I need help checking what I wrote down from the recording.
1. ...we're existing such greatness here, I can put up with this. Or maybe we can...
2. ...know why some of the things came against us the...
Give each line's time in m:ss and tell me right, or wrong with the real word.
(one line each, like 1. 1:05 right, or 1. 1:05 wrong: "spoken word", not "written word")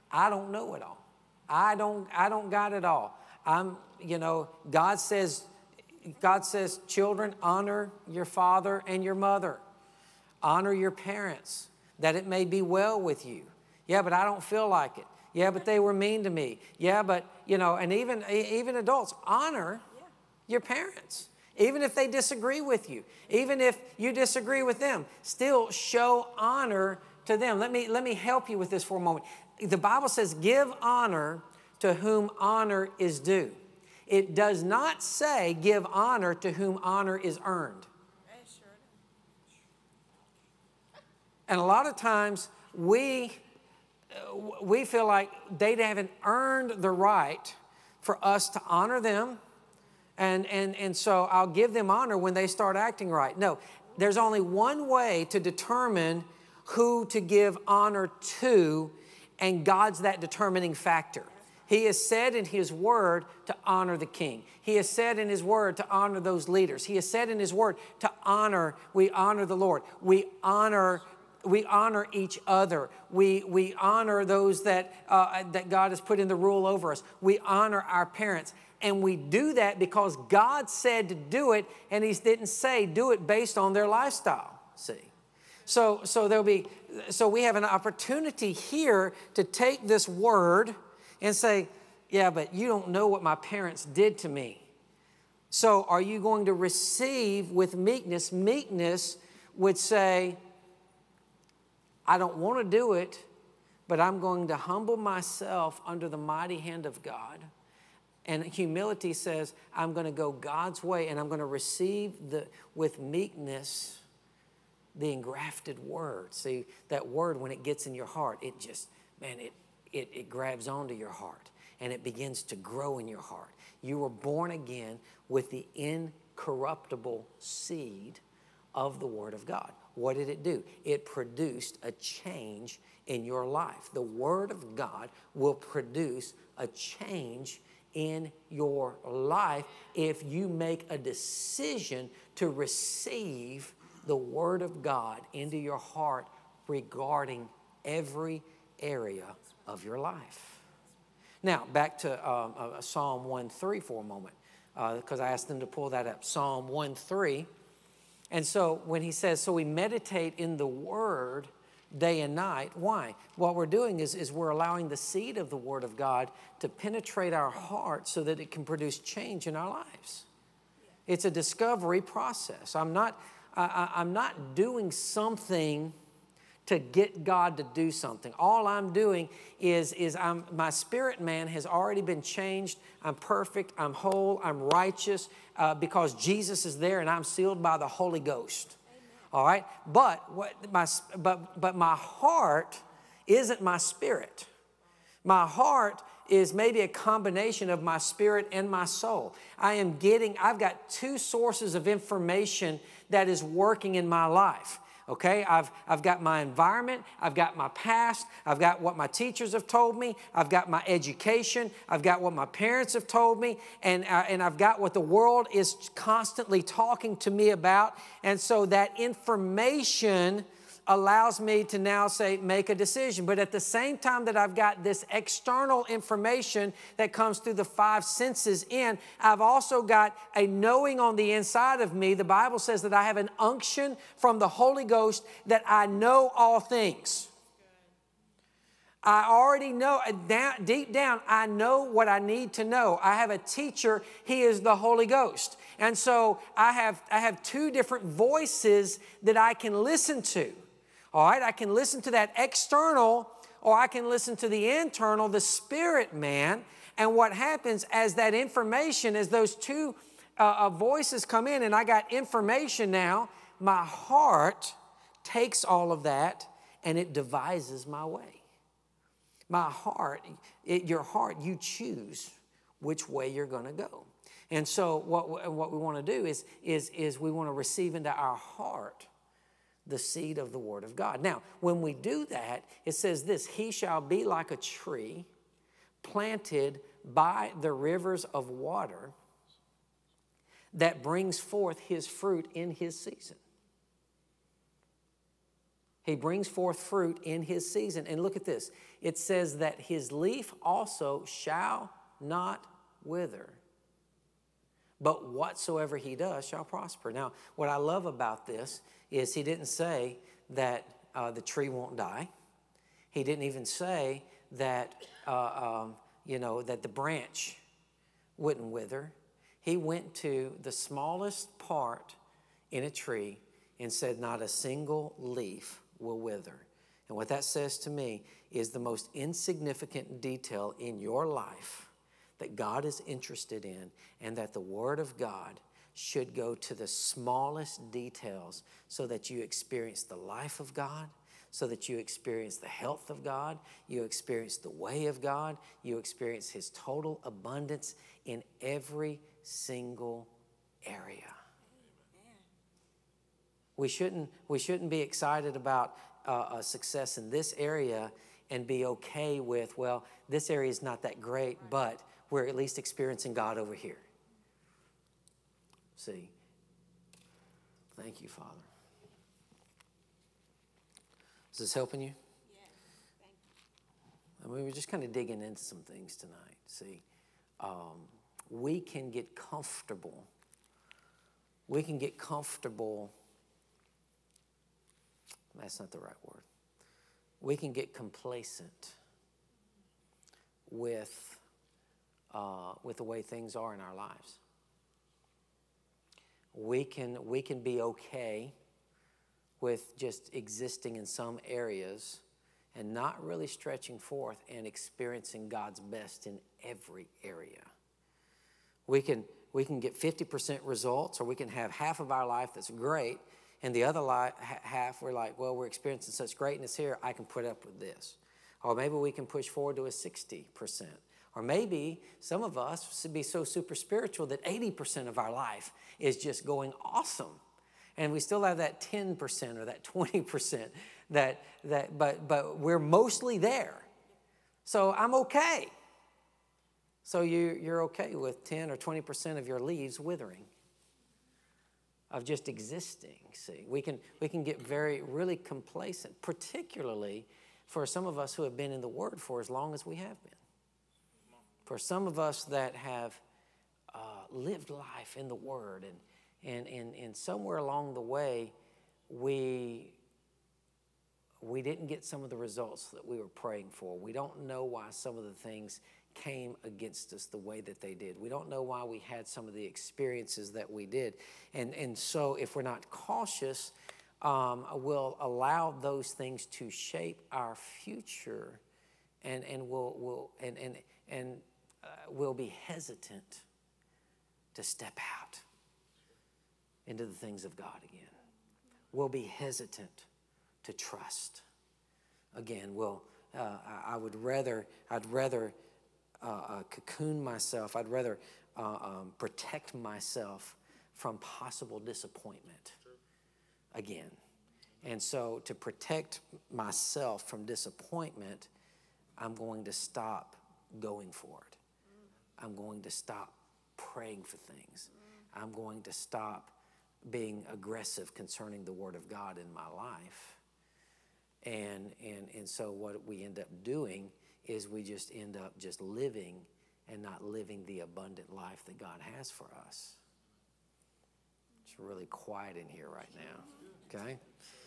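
1. 6:55 wrong: "experiencing", not "existing"
2. 7:44 right.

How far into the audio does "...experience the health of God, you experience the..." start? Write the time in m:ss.
5:41.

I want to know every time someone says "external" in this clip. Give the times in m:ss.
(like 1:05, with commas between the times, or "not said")
3:45, 4:12.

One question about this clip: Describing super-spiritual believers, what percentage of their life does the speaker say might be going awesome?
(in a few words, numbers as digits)
80%.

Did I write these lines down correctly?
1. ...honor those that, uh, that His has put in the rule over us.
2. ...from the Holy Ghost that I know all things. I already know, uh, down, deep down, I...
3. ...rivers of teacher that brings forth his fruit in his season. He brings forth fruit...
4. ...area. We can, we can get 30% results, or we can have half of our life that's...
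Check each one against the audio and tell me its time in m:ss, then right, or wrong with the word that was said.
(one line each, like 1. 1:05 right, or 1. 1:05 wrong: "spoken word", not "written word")
1. 1:13 wrong: "God", not "His"
2. 3:54 right
3. 4:47 wrong: "water", not "teacher"
4. 6:47 wrong: "50", not "30".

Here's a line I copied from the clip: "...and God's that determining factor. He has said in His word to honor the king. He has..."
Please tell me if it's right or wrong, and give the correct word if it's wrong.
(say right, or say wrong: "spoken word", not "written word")
right.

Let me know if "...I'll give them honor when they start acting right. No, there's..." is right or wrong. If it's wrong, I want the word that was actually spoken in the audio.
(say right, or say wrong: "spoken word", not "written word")
right.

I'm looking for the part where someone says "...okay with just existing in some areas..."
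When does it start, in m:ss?
6:37.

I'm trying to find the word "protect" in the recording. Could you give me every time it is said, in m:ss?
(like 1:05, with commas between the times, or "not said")
8:19, 8:25.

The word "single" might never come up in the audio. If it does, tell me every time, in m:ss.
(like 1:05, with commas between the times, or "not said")
5:24, 5:49.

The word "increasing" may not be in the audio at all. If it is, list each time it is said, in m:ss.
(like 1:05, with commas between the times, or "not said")
not said.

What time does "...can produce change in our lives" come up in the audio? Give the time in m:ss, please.
2:48.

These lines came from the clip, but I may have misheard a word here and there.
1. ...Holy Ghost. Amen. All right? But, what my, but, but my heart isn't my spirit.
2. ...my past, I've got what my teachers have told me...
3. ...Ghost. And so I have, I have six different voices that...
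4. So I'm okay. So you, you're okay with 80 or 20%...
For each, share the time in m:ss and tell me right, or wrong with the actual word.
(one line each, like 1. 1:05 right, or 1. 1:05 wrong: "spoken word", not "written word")
1. 3:07 right
2. 3:27 right
3. 4:05 wrong: "two", not "six"
4. 7:14 wrong: "10", not "80".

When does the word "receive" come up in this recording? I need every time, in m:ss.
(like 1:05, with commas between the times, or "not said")
1:36, 1:51, 2:22, 4:37.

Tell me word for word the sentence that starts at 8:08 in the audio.
We'll be hesitant to trust again.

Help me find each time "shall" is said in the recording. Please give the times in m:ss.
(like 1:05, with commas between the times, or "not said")
4:43, 5:01, 5:06.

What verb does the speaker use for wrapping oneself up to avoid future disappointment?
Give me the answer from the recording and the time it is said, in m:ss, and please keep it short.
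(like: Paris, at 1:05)
cocoon, at 8:16.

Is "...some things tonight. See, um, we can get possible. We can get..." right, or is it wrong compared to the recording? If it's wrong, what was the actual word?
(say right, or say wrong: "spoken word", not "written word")
wrong: "comfortable", not "possible".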